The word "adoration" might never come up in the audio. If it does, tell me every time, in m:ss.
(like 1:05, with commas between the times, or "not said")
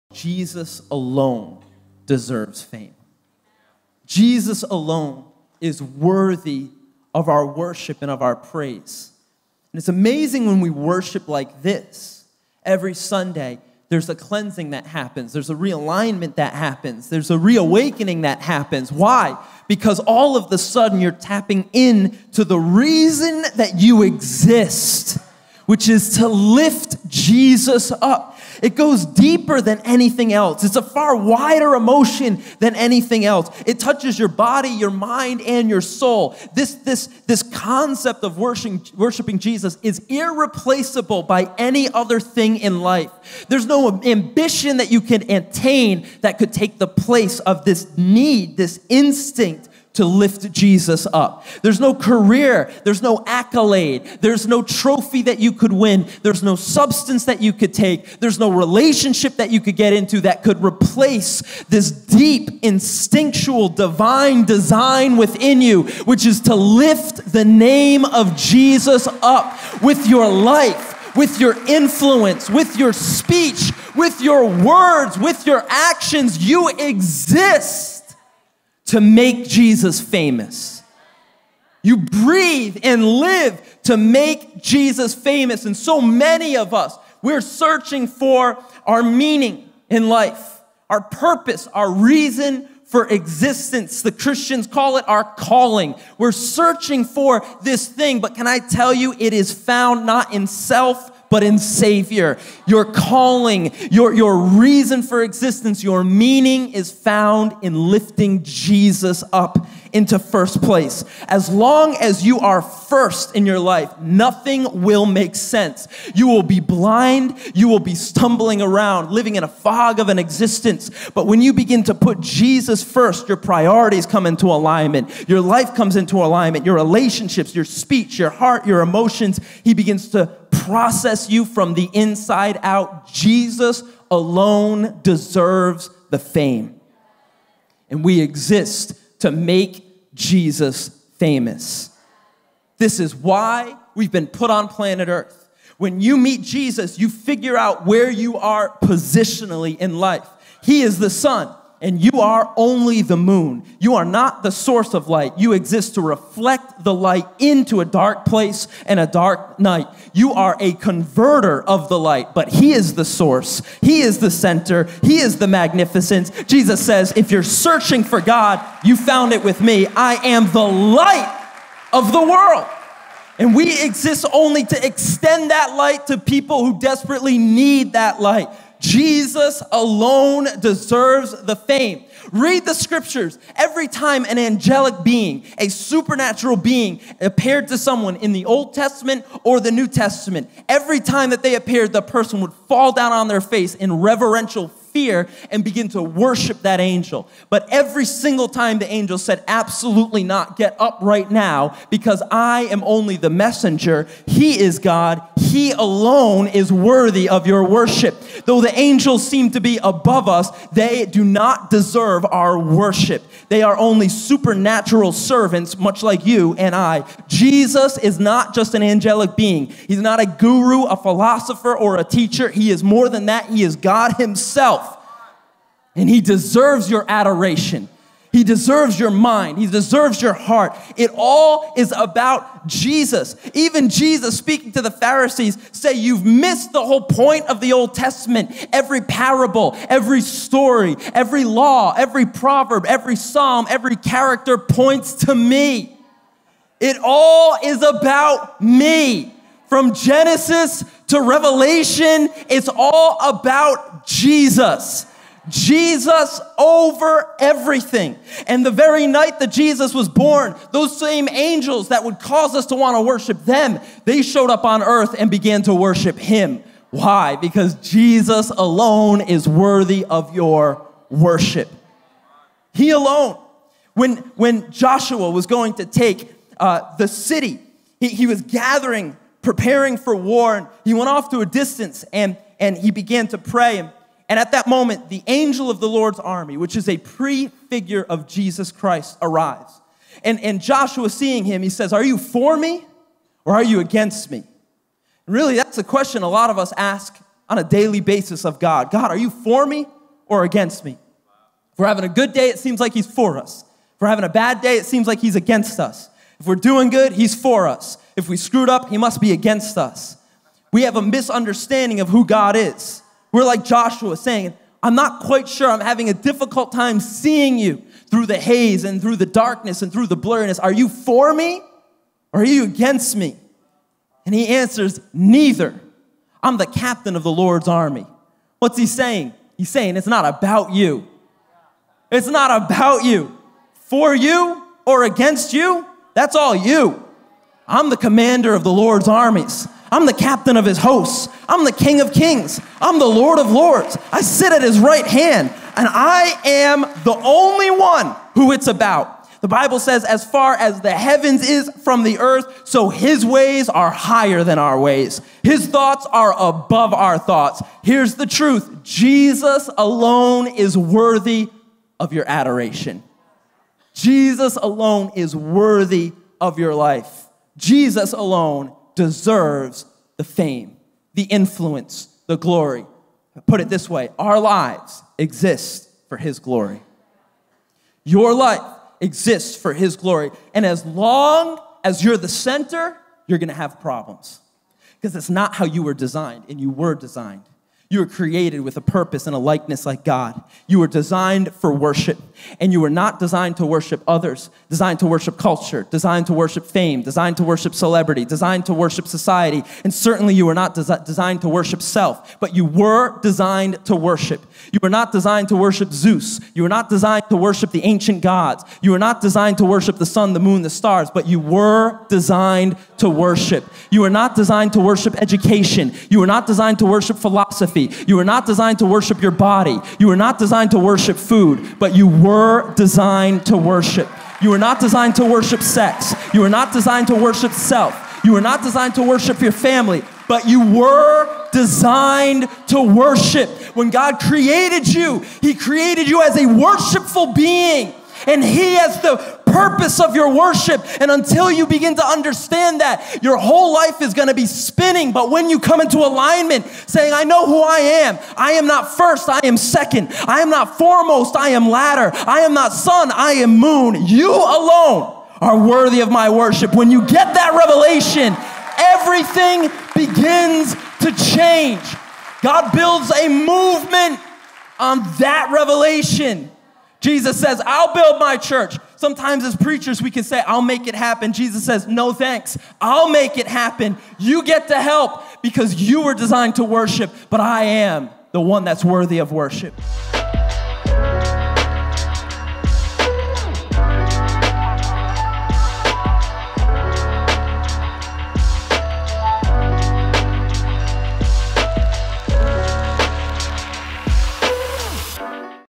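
3:47, 6:02.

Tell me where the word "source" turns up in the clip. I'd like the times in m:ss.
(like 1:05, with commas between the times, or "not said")
2:34, 2:43.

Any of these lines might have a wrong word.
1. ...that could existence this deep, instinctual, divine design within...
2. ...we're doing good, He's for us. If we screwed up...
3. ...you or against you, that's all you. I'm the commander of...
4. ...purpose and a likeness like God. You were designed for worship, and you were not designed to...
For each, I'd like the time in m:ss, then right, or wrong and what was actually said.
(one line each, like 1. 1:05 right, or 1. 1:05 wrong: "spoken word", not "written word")
1. 1:00 wrong: "replace", not "existence"
2. 5:06 right
3. 5:34 right
4. 6:28 right.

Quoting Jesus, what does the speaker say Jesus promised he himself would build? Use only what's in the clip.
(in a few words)
my church.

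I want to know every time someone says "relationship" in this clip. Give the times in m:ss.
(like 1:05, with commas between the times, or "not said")
0:58, 2:06.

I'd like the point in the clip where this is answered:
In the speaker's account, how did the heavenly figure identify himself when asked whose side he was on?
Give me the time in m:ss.
5:26.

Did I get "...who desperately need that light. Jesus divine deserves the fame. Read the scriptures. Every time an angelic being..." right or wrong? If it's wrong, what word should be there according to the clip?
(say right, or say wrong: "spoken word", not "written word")
wrong: "alone", not "divine".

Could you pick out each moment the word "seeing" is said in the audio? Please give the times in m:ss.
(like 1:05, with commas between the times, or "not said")
4:51, 5:16.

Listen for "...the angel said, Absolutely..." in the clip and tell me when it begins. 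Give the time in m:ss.
3:18.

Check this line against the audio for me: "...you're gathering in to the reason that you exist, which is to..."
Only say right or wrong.
wrong.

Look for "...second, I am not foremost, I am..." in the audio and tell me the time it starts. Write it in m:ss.
7:29.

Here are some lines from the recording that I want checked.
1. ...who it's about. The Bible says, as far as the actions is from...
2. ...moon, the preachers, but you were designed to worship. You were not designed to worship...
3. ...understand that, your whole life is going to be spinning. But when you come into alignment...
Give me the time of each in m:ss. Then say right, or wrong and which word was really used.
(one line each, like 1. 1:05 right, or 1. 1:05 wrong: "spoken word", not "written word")
1. 5:48 wrong: "heavens", not "actions"
2. 6:50 wrong: "stars", not "preachers"
3. 7:22 right.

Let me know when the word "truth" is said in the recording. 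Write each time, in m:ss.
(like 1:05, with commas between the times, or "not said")
5:58.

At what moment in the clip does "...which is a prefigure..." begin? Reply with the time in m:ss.
4:46.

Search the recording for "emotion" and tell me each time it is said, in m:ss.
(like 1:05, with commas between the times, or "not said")
0:31, 2:08.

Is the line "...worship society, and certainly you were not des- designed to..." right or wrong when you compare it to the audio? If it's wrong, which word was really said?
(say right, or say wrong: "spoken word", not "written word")
right.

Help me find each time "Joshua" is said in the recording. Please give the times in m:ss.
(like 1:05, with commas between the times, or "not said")
4:34, 4:50, 5:13.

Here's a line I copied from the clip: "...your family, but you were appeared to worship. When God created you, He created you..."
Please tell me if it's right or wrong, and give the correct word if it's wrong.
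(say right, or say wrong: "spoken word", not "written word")
wrong: "designed", not "appeared".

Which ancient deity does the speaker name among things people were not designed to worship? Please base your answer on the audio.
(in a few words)
Zeus.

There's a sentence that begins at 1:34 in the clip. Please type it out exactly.
The Christians call it our calling.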